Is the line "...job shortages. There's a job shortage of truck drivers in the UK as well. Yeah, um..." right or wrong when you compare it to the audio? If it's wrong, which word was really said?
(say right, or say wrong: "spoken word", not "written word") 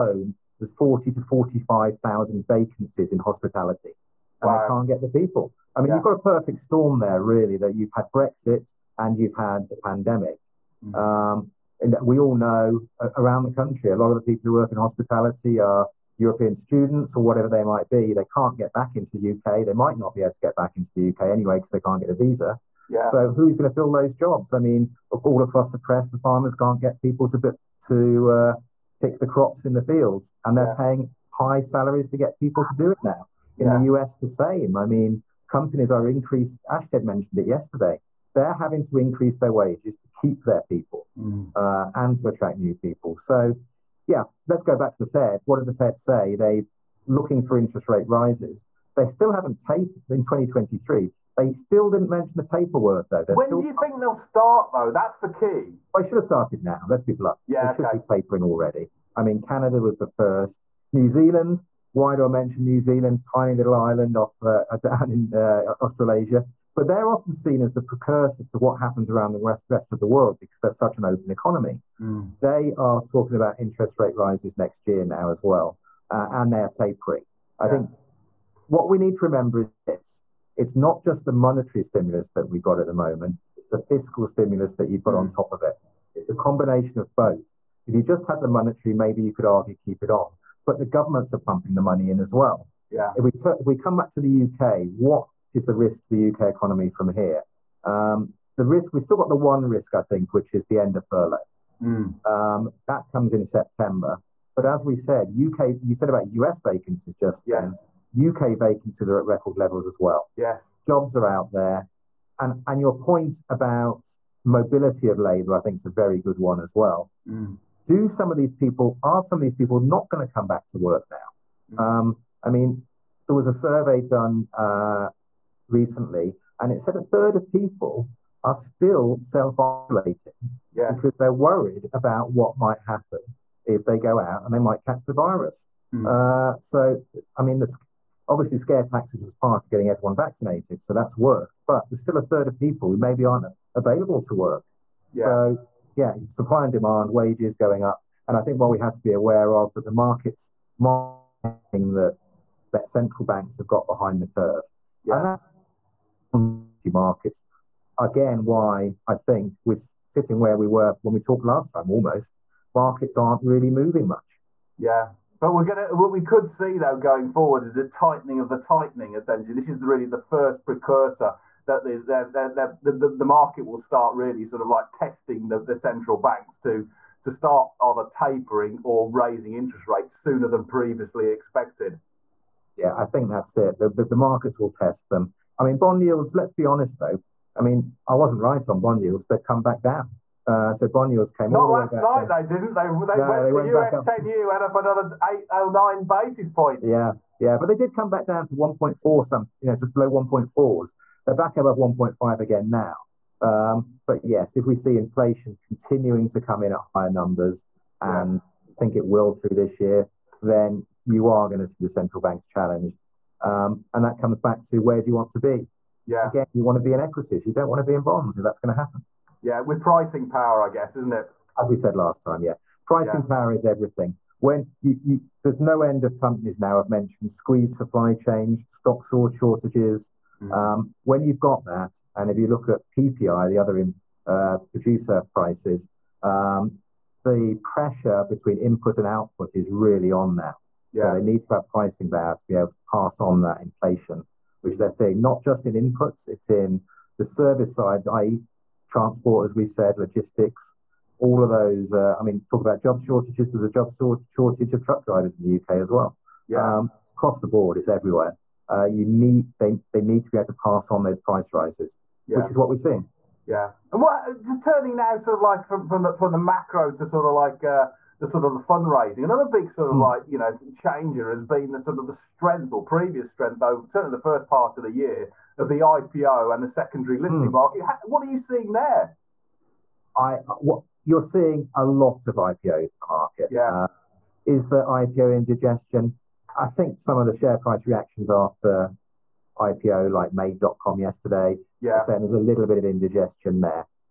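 right.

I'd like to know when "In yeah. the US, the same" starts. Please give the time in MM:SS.
00:33.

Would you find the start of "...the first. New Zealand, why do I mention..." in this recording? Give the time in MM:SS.
00:59.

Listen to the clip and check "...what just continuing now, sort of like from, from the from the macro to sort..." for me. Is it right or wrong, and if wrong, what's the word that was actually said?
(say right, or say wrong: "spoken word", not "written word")
wrong: "turning", not "continuing".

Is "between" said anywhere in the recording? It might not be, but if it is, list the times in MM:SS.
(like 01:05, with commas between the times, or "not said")
03:58.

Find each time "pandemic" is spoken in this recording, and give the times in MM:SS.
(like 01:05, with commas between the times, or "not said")
00:09.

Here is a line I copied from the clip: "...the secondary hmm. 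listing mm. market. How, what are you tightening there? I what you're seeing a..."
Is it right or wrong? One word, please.
wrong.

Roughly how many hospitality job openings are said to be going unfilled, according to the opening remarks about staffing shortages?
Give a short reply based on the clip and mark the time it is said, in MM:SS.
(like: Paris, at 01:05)
40 to 45,000, at 00:00.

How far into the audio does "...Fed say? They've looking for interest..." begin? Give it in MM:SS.
00:45.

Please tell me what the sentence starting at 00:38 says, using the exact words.
They're having to increase their wages to keep their people mm.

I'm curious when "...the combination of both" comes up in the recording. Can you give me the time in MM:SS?
01:26.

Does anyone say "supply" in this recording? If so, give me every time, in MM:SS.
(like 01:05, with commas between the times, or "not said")
02:26, 03:47.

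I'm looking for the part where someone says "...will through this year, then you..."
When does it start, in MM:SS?
03:29.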